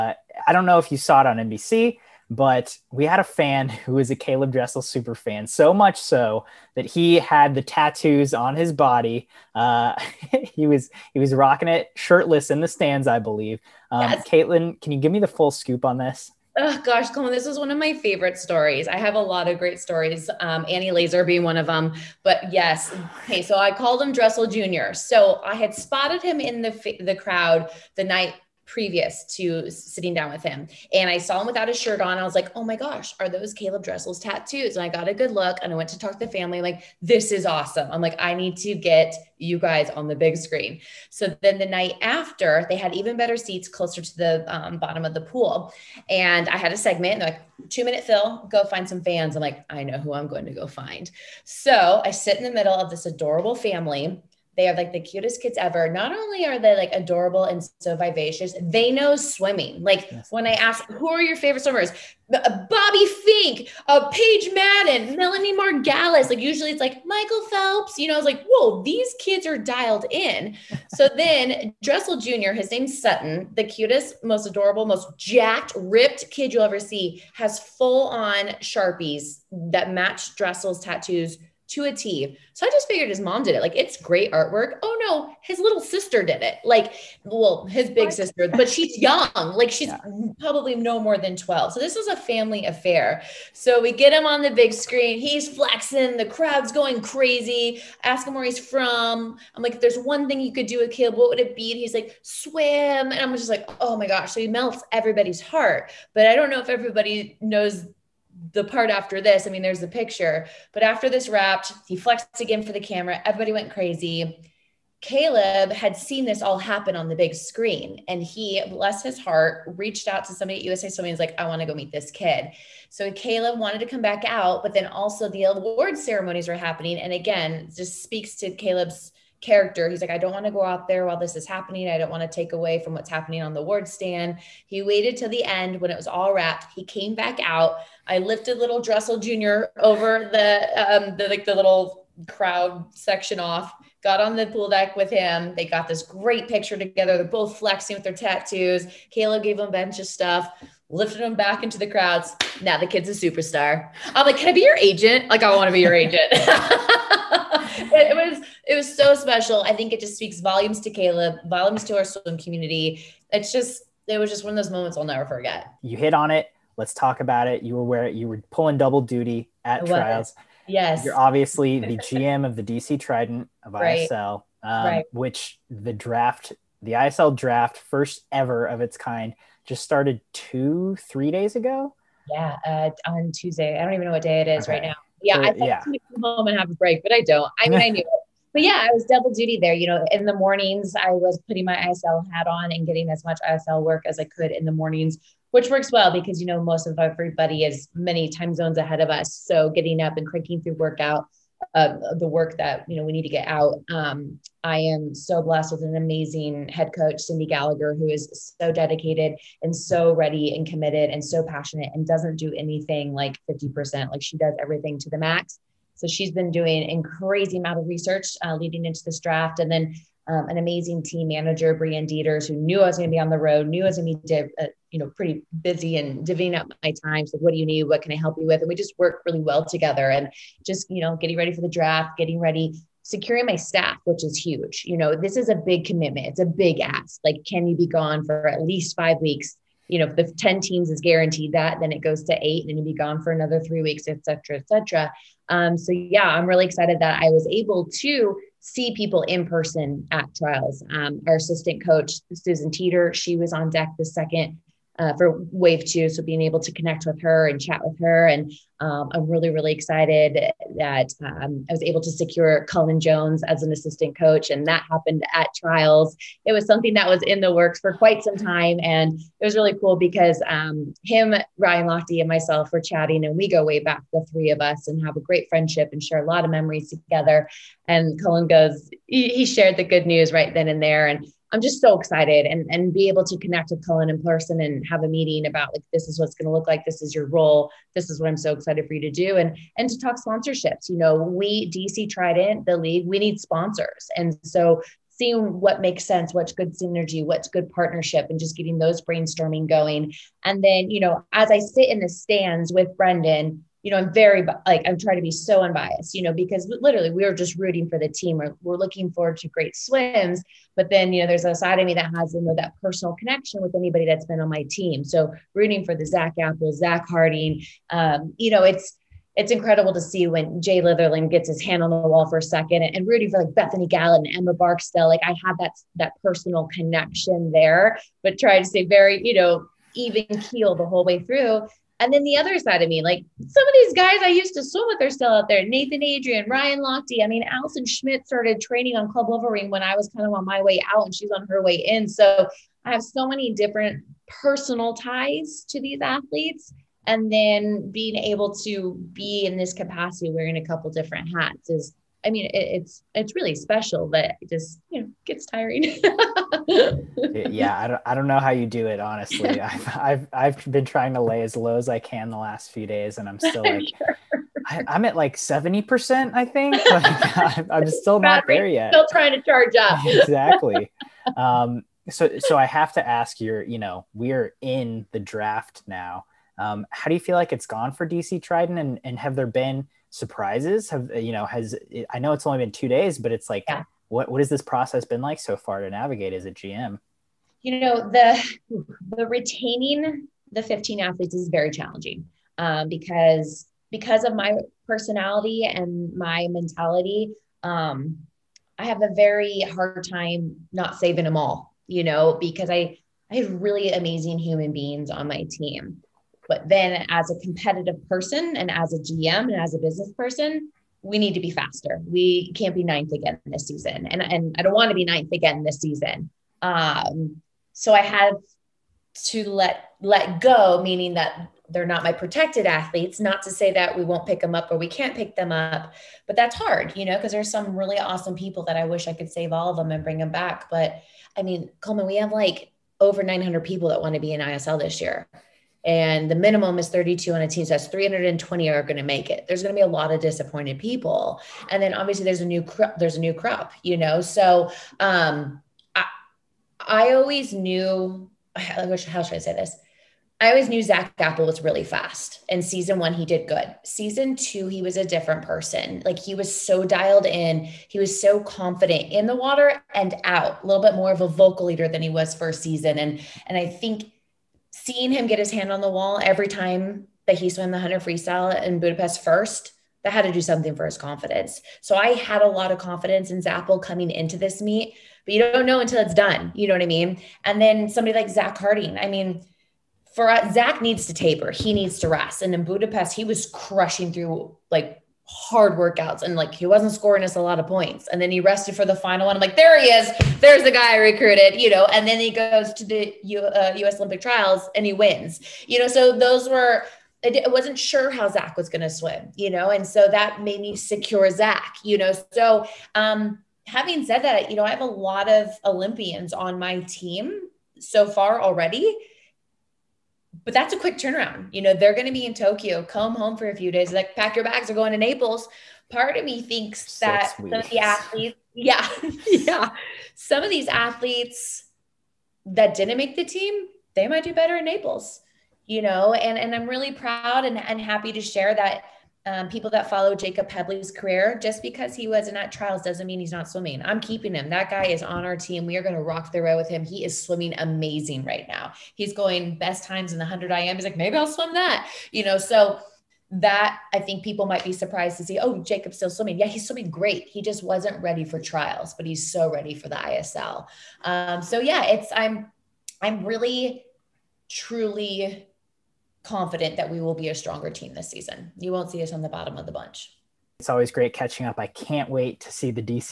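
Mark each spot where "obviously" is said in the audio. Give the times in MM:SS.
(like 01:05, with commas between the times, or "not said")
02:51, 07:21.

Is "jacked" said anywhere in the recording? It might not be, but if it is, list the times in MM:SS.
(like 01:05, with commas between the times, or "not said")
01:15.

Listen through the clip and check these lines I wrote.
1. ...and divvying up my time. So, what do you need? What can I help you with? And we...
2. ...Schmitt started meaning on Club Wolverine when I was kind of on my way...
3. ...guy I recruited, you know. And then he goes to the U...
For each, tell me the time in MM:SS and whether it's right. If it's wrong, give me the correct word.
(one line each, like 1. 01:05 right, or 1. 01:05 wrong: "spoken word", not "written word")
1. 03:45 right
2. 05:37 wrong: "training", not "meaning"
3. 08:10 right.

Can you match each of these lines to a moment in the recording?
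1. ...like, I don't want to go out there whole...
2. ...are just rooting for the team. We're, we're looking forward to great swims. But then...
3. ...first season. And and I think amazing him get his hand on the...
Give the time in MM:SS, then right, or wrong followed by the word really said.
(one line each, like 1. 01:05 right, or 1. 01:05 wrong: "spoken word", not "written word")
1. 02:10 wrong: "while", not "whole"
2. 05:07 right
3. 07:42 wrong: "seeing", not "amazing".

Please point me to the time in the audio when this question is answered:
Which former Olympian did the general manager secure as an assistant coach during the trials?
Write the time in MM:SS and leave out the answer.
04:22.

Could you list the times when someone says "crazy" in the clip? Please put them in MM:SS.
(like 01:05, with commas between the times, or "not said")
01:37, 01:53, 03:37.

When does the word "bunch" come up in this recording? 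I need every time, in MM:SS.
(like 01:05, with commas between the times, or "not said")
02:29, 09:19.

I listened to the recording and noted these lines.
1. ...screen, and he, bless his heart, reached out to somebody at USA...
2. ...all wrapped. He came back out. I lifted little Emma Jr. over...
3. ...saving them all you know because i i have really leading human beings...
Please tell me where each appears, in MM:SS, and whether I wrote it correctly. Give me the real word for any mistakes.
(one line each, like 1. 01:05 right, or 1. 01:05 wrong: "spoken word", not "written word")
1. 01:57 right
2. 02:16 wrong: "Dressel", not "Emma"
3. 06:40 wrong: "amazing", not "leading".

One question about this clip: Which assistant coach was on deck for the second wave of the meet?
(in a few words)
Susan Teeter.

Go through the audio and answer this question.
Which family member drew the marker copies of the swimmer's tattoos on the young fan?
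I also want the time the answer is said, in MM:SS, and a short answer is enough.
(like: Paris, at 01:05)
His big sister, at 01:27.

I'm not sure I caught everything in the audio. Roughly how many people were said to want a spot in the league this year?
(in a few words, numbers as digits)
Over 900.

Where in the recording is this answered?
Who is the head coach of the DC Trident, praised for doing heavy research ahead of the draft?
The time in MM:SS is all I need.
03:27.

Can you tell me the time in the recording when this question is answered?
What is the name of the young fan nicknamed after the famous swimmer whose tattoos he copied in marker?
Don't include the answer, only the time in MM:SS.
01:12.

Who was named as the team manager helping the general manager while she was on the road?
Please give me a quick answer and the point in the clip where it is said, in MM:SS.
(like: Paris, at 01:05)
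Brian Dieters, at 03:41.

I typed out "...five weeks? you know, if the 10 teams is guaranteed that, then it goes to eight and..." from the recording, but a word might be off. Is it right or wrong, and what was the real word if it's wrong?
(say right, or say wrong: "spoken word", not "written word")
right.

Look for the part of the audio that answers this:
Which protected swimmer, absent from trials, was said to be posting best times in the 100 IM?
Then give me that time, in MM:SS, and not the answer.
08:50.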